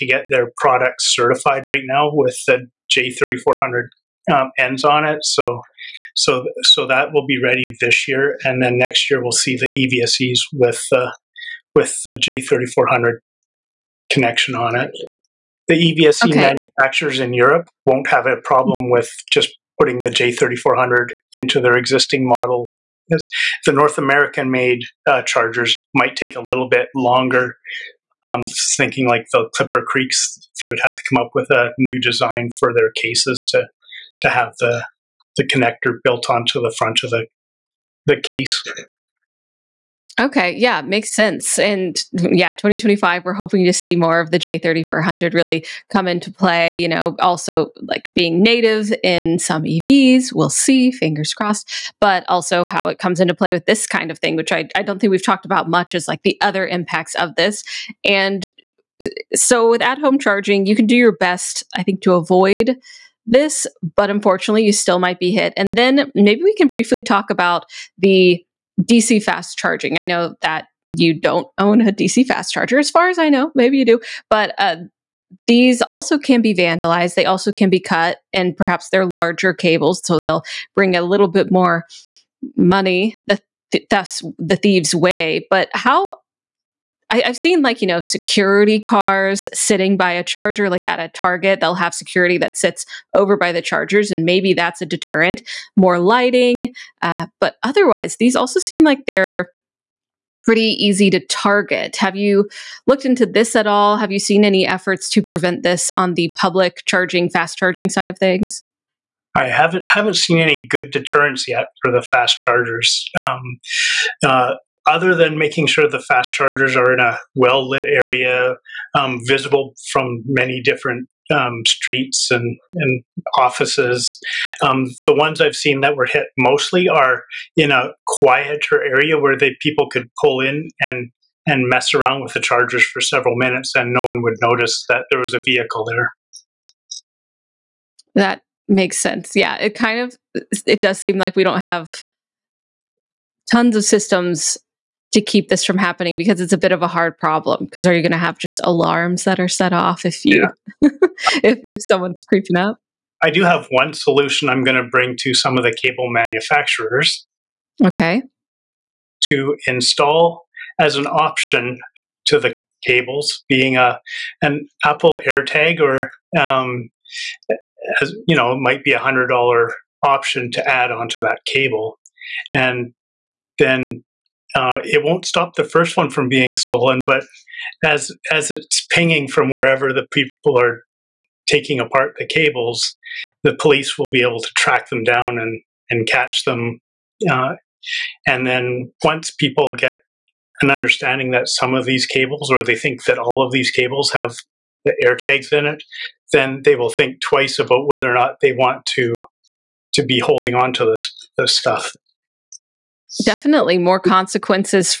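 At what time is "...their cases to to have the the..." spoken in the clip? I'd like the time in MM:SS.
00:32.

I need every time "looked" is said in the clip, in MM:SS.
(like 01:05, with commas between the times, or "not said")
01:42.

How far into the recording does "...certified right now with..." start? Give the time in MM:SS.
00:01.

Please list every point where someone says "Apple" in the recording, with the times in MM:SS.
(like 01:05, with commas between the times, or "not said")
02:44.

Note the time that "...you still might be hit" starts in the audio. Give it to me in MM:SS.
01:04.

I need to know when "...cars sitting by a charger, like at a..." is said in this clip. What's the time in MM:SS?
01:28.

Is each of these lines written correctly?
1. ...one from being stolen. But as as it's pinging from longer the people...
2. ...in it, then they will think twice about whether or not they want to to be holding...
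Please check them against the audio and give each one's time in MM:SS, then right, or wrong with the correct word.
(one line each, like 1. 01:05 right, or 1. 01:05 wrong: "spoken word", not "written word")
1. 02:55 wrong: "wherever", not "longer"
2. 03:15 right.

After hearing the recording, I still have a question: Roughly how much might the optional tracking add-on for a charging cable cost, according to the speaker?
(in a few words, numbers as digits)
$100.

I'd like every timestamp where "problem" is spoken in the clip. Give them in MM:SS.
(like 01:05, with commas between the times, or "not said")
00:18, 02:27.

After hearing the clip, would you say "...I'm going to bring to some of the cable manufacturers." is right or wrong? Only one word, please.
right.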